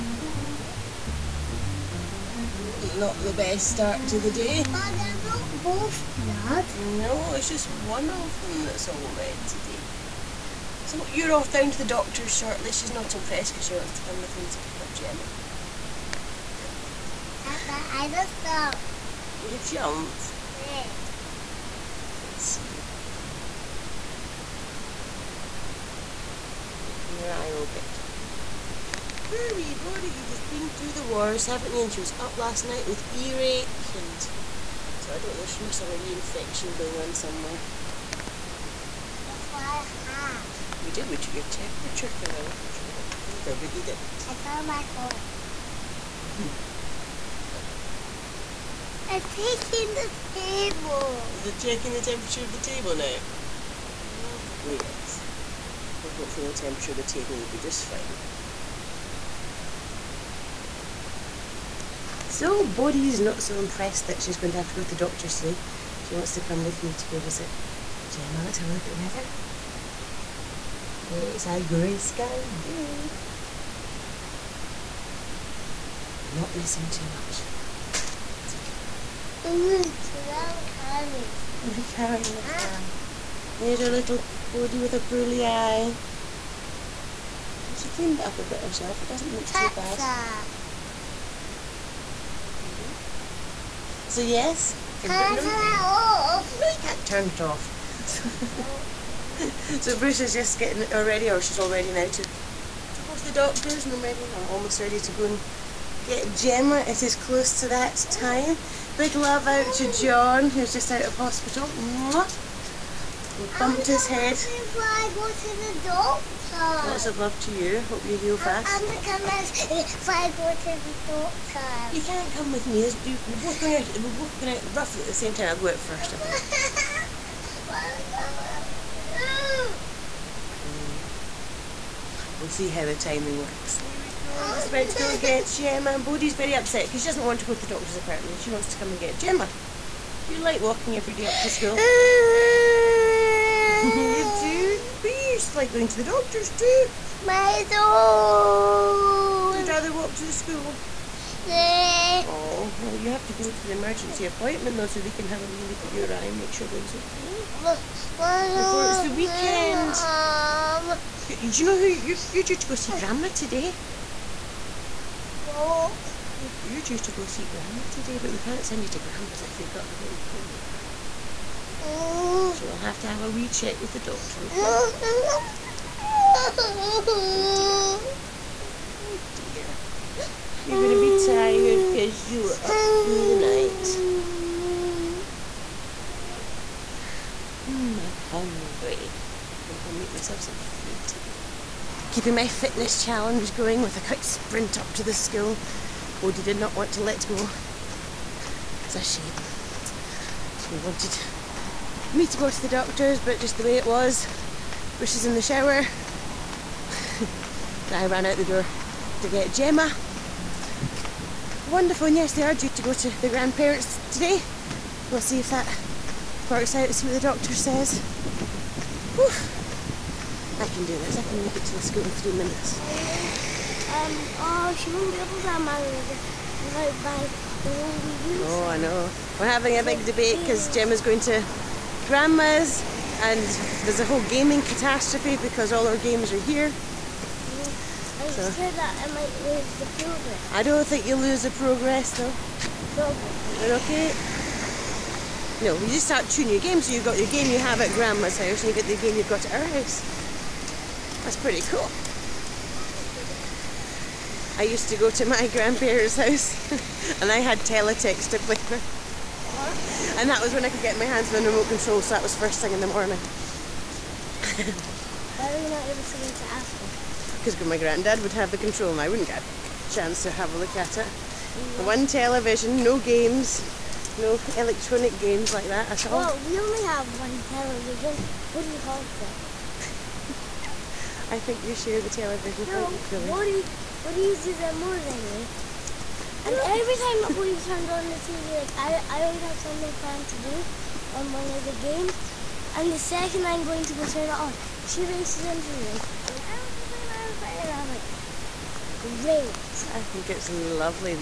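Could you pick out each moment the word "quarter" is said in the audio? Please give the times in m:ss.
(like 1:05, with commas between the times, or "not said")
not said.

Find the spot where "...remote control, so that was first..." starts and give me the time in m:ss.
4:21.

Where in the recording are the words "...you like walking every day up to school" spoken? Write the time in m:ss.
2:20.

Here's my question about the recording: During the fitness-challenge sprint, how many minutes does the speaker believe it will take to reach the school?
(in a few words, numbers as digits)
3 minutes.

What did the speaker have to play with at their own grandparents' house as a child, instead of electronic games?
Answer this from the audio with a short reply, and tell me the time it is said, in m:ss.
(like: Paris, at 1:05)
Teletext, at 4:17.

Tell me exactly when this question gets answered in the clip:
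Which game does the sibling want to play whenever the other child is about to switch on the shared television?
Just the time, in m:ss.
4:57.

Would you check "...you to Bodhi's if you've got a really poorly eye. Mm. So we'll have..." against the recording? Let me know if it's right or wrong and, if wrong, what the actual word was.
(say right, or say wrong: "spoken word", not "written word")
wrong: "Grandma", not "Bodhi".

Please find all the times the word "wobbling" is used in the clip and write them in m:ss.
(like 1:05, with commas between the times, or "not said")
not said.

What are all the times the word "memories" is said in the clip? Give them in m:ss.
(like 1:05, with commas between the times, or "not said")
not said.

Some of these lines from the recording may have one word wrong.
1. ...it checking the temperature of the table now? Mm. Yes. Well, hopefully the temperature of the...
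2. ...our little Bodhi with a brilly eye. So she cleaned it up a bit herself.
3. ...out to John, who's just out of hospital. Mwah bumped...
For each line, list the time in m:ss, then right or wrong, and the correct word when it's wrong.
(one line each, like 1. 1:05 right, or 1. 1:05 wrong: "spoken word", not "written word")
1. 0:51 right
2. 1:23 right
3. 1:49 right.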